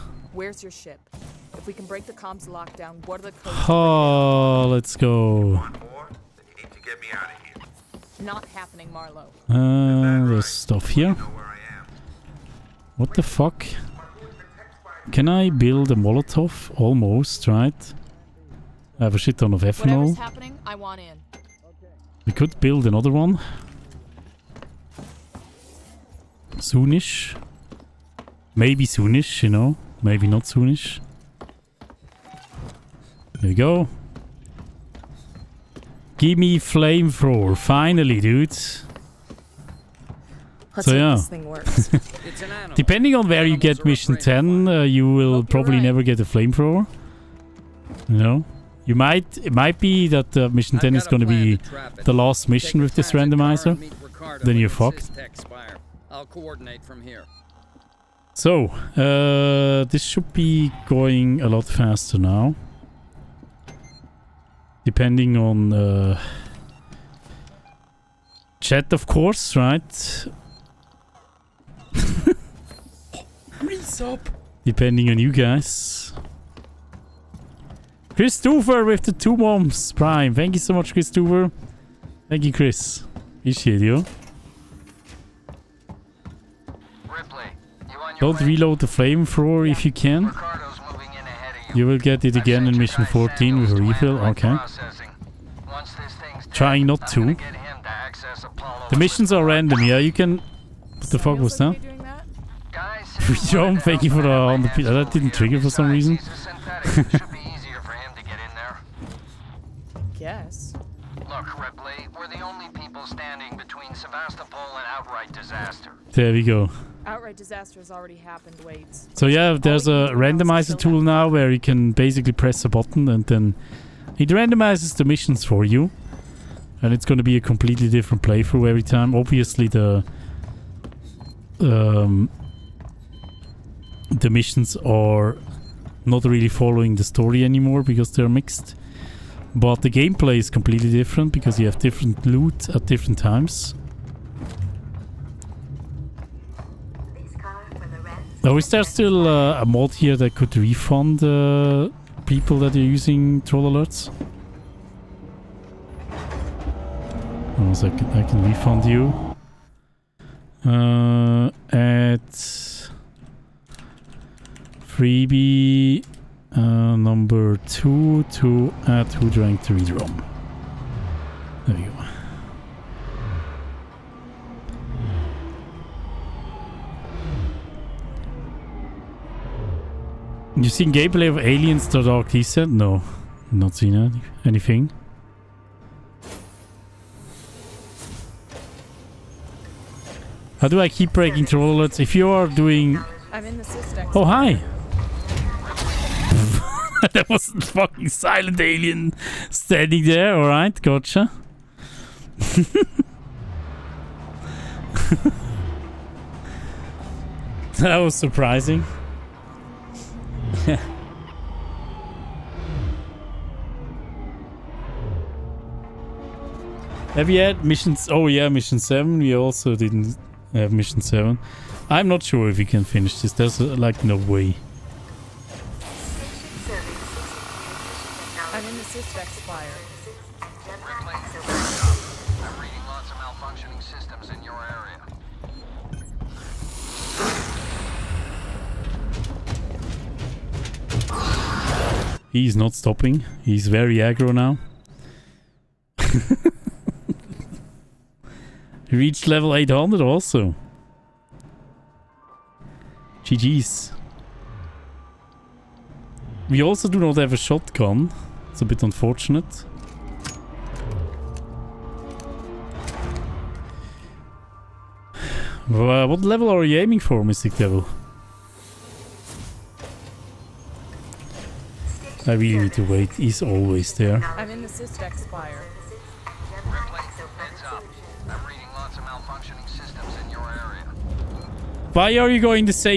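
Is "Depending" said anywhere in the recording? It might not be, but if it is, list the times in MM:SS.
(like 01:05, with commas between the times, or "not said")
00:42, 01:04, 01:14.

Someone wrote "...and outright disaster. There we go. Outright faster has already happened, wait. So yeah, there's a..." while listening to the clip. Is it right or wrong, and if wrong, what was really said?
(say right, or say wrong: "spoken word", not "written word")
wrong: "disaster", not "faster".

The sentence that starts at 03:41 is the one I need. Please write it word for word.
I'm not sure if we can finish this.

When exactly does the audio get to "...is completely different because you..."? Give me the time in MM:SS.
02:20.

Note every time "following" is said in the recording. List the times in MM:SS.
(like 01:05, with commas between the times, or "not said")
02:16.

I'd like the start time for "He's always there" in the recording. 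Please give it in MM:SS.
04:33.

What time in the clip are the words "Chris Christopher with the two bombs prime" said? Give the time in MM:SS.
01:18.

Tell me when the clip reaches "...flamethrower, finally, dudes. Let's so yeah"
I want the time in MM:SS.
00:36.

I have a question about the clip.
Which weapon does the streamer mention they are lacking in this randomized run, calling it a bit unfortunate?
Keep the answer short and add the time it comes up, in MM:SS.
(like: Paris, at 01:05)
shotgun, at 04:17.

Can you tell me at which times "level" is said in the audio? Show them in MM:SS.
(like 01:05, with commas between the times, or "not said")
04:09, 04:26.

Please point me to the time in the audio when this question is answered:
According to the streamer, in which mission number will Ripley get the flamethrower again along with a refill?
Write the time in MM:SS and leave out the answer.
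01:32.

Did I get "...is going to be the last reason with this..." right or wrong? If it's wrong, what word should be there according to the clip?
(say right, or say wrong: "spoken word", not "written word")
wrong: "mission", not "reason".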